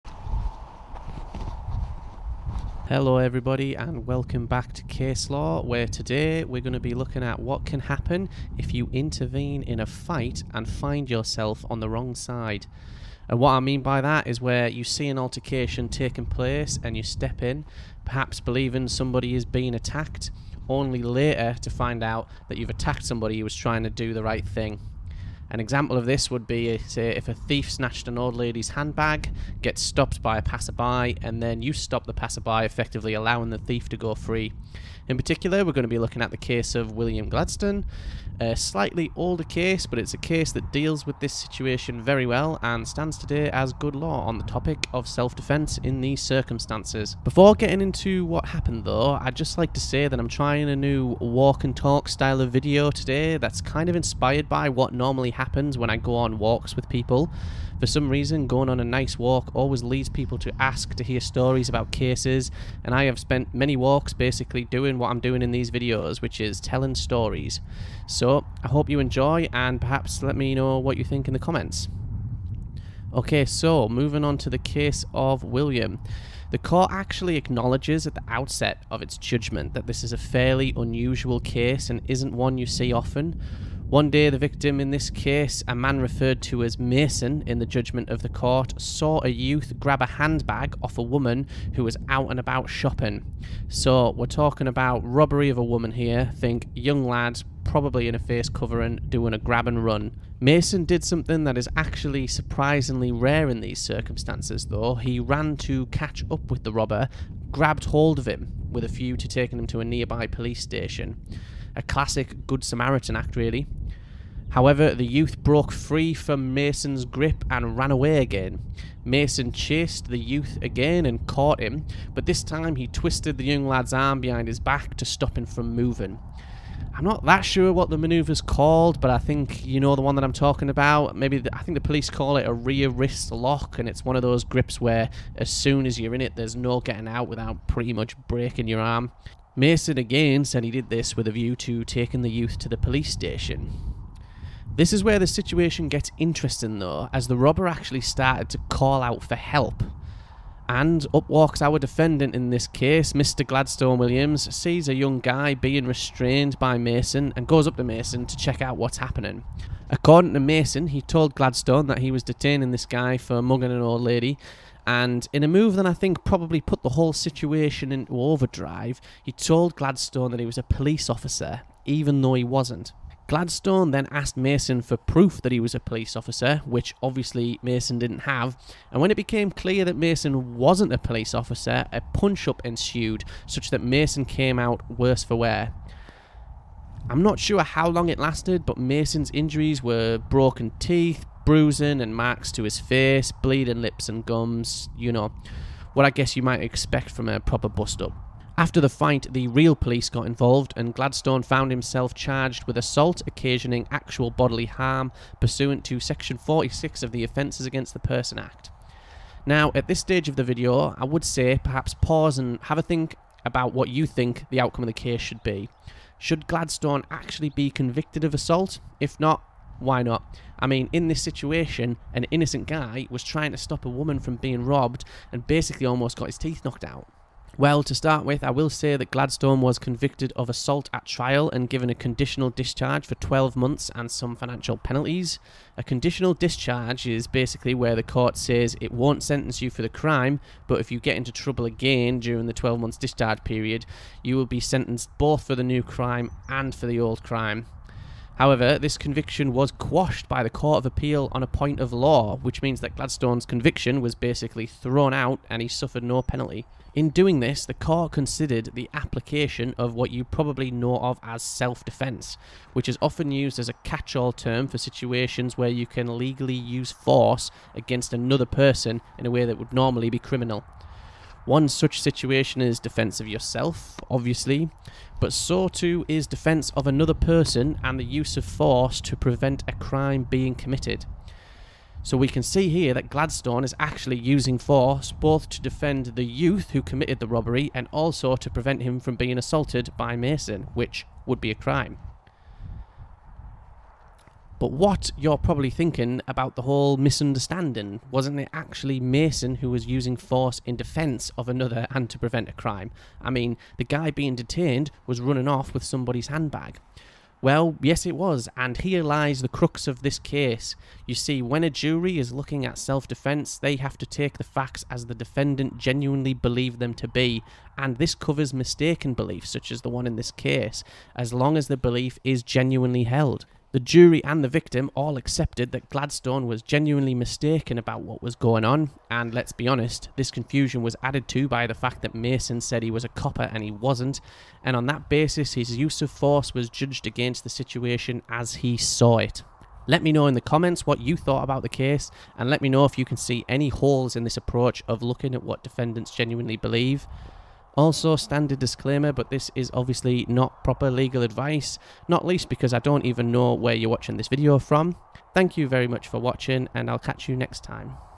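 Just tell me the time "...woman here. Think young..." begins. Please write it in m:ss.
1:35.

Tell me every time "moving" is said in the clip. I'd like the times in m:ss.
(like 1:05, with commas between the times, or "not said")
1:13, 2:05.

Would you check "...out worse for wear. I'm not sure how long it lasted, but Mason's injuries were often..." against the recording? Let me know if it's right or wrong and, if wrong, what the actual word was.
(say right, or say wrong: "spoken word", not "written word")
wrong: "broken", not "often".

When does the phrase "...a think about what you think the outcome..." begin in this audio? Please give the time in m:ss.
3:32.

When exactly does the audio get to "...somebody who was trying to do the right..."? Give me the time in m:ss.
0:23.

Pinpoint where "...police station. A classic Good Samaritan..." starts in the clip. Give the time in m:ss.
1:50.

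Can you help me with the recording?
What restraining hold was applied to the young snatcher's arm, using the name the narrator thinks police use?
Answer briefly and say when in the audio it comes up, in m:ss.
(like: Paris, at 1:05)
Rear wrist lock, at 2:12.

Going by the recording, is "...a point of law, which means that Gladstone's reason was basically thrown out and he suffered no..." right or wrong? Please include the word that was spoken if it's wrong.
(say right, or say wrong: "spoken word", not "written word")
wrong: "conviction", not "reason".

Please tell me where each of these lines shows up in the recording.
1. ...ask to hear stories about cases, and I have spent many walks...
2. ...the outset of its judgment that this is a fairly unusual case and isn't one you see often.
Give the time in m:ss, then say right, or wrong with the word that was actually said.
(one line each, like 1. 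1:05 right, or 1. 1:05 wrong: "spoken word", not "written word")
1. 1:00 right
2. 1:18 right.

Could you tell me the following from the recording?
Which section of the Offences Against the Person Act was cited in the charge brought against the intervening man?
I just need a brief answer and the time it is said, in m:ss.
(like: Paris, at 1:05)
Section 46, at 3:25.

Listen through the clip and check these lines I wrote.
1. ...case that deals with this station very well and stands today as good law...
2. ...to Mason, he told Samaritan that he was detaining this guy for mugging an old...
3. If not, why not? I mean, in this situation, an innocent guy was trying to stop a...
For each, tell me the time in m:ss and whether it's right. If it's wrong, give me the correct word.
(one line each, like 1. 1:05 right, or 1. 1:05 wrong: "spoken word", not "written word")
1. 0:40 wrong: "situation", not "station"
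2. 2:40 wrong: "Gladstone", not "Samaritan"
3. 3:38 right.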